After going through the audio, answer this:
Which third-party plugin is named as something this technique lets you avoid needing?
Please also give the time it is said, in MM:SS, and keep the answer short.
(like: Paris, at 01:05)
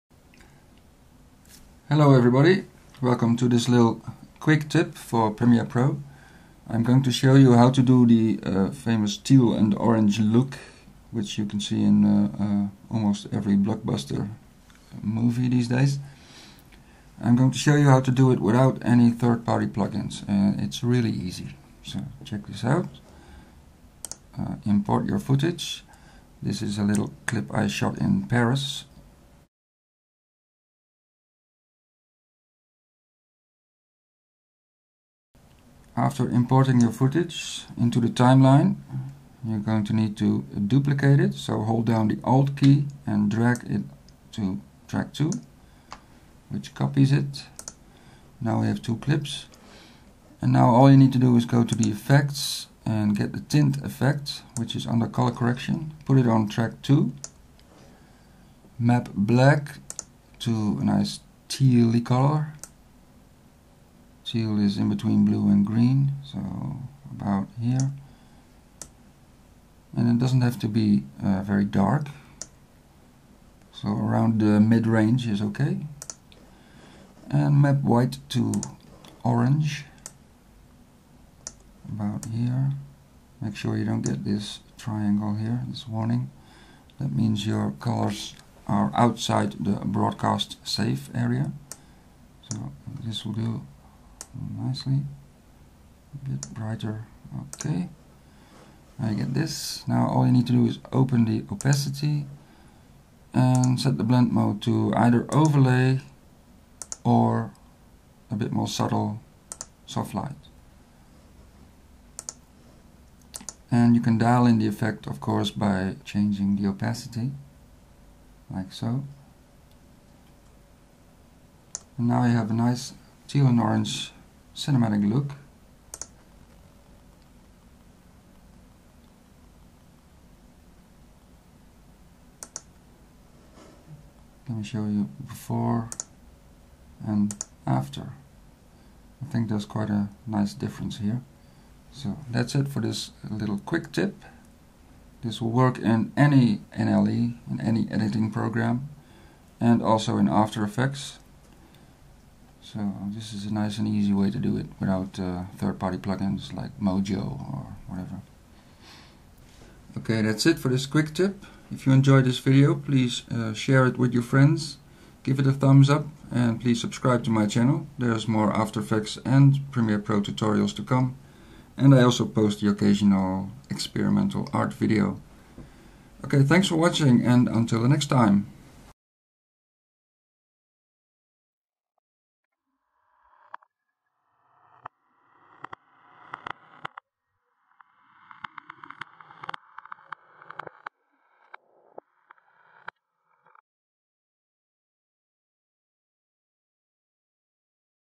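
Mojo, at 02:36.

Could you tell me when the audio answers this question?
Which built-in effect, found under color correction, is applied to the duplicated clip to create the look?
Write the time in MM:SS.
00:53.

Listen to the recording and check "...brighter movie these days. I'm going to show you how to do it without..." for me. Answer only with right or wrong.
wrong.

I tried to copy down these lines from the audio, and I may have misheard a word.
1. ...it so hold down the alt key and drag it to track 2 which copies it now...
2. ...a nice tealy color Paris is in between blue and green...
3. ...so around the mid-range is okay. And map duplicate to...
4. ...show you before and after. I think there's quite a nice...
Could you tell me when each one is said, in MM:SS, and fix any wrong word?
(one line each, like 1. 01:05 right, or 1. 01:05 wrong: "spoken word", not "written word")
1. 00:41 right
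2. 01:00 wrong: "Teal", not "Paris"
3. 01:13 wrong: "white", not "duplicate"
4. 02:14 right.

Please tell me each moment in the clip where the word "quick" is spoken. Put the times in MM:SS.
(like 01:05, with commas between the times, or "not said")
00:04, 02:23, 02:40.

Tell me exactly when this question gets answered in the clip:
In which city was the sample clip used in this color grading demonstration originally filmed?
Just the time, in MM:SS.
00:28.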